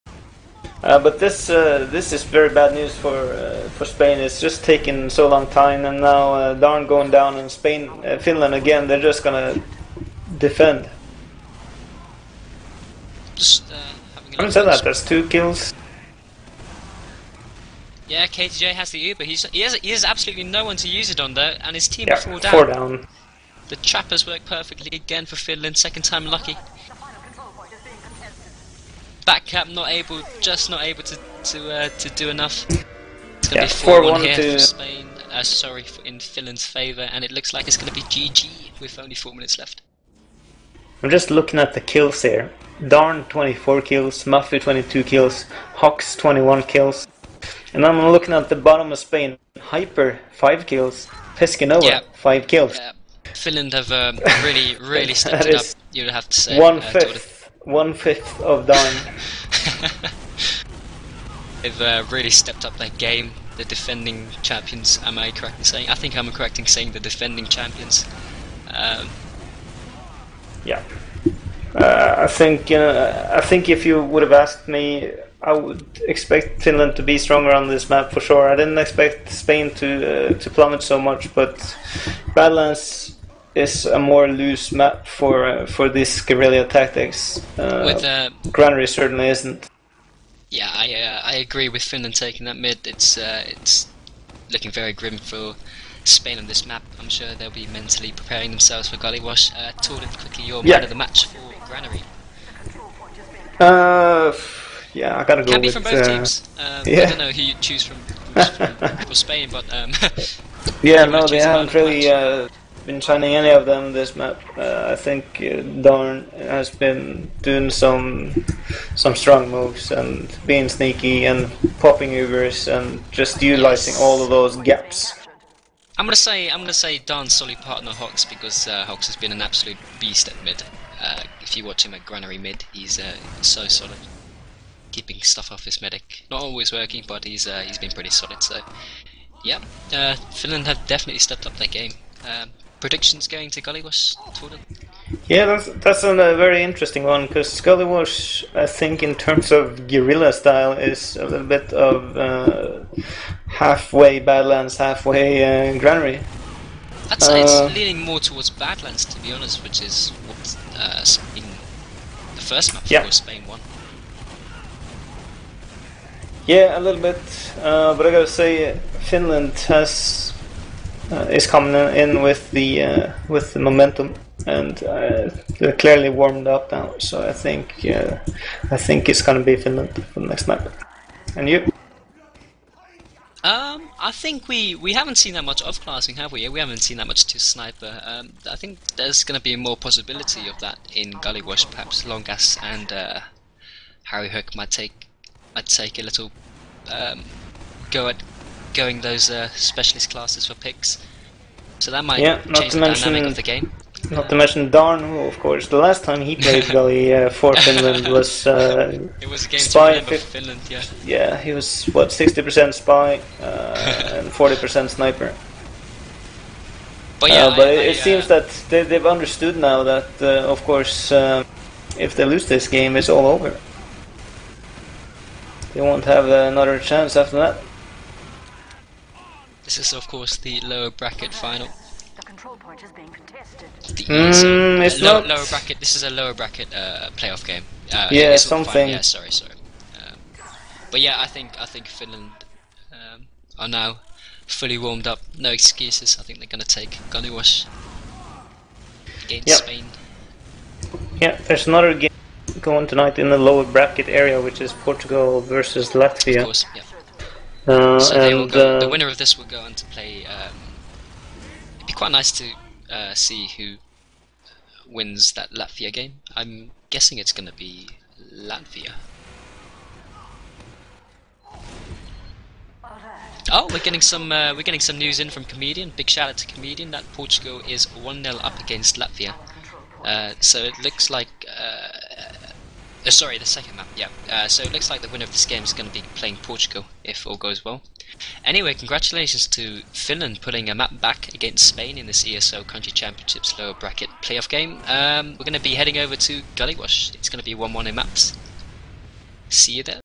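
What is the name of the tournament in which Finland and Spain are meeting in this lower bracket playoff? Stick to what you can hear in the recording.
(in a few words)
ESL Country Championships.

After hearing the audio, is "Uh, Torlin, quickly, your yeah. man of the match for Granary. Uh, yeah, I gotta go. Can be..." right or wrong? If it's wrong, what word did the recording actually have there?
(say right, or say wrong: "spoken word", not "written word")
right.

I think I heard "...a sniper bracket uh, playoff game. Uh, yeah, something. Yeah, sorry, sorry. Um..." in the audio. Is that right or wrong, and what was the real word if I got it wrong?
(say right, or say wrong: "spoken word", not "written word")
wrong: "lower", not "sniper".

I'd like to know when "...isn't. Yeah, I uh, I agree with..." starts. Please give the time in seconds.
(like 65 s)
89 s.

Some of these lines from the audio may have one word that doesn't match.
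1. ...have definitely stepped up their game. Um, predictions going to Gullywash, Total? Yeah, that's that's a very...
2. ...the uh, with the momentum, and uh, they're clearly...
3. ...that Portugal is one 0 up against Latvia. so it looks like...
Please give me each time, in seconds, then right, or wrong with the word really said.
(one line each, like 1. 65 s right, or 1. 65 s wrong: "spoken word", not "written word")
1. 140 s right
2. 172 s right
3. 276 s right.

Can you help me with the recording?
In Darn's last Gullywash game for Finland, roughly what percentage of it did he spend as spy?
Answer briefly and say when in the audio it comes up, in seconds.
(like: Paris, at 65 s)
60%, at 212 s.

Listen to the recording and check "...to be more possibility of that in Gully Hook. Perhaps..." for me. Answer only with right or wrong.
wrong.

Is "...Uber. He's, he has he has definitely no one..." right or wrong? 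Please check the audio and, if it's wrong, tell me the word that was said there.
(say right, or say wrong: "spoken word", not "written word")
wrong: "absolutely", not "definitely".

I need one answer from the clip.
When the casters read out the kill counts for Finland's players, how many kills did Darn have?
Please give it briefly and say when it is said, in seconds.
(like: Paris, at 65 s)
24, at 42 s.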